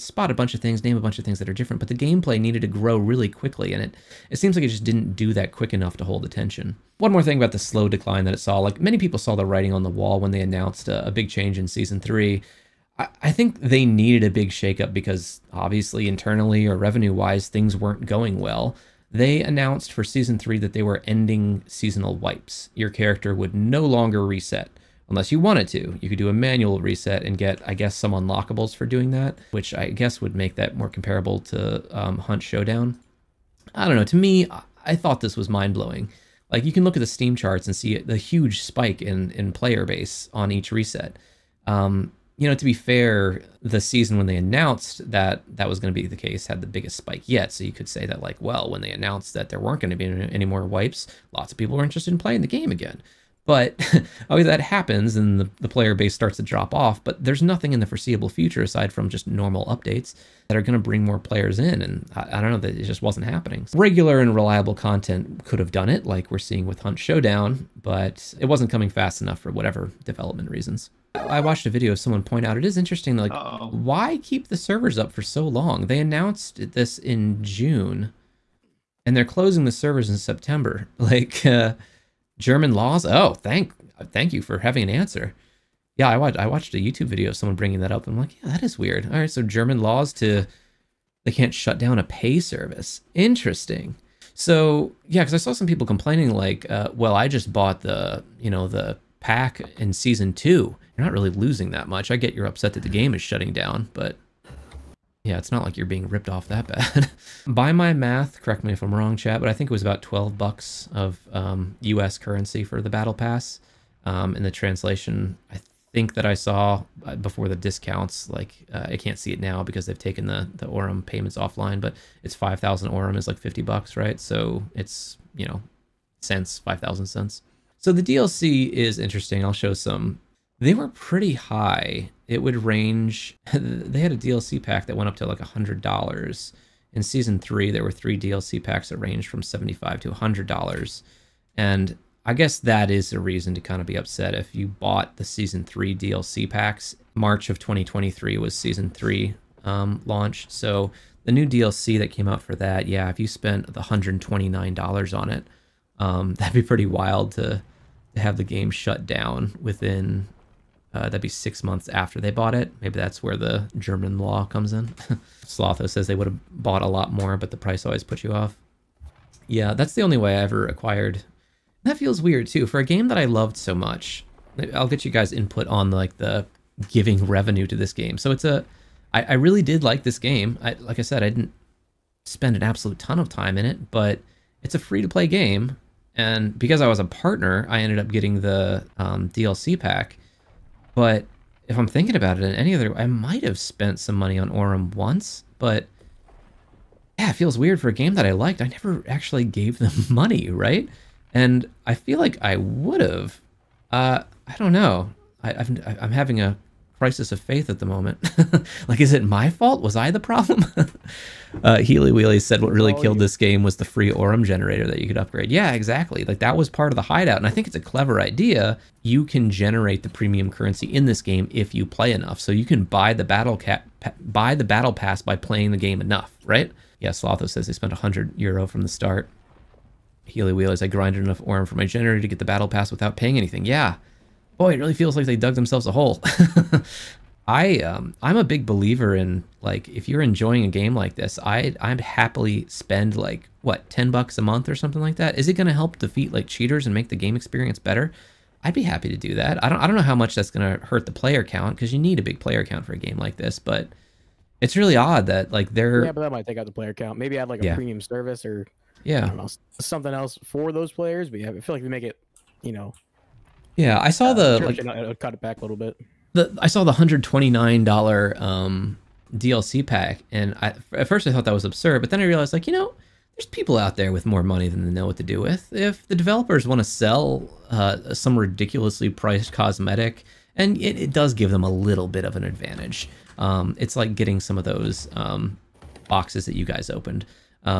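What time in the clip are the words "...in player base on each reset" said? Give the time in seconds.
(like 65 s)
39 s.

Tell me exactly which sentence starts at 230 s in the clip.
Healy Wheelers, I grinded enough Aurum for my generator to get the battle pass without paying anything.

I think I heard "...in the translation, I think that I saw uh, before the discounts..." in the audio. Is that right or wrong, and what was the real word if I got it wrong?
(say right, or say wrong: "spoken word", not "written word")
right.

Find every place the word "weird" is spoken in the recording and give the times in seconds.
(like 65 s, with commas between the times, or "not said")
88 s, 172 s, 197 s.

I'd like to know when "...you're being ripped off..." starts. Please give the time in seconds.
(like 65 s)
105 s.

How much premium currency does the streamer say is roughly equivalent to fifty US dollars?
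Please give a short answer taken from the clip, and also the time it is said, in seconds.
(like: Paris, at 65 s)
5,000 Aurum, at 122 s.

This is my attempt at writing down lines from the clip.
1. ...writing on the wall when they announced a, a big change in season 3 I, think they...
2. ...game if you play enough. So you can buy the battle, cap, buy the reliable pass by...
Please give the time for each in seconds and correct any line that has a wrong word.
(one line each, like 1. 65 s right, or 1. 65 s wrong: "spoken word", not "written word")
1. 9 s right
2. 221 s wrong: "battle", not "reliable".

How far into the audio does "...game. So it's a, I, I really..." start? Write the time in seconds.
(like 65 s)
177 s.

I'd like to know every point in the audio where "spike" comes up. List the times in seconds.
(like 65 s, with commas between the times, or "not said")
38 s, 46 s.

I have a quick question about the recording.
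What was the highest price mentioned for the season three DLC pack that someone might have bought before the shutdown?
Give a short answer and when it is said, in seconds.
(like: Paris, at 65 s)
$129, at 153 s.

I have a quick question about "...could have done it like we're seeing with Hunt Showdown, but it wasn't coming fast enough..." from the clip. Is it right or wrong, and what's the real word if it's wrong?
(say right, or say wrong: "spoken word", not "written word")
right.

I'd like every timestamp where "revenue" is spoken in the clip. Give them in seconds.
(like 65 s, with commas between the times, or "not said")
16 s, 177 s.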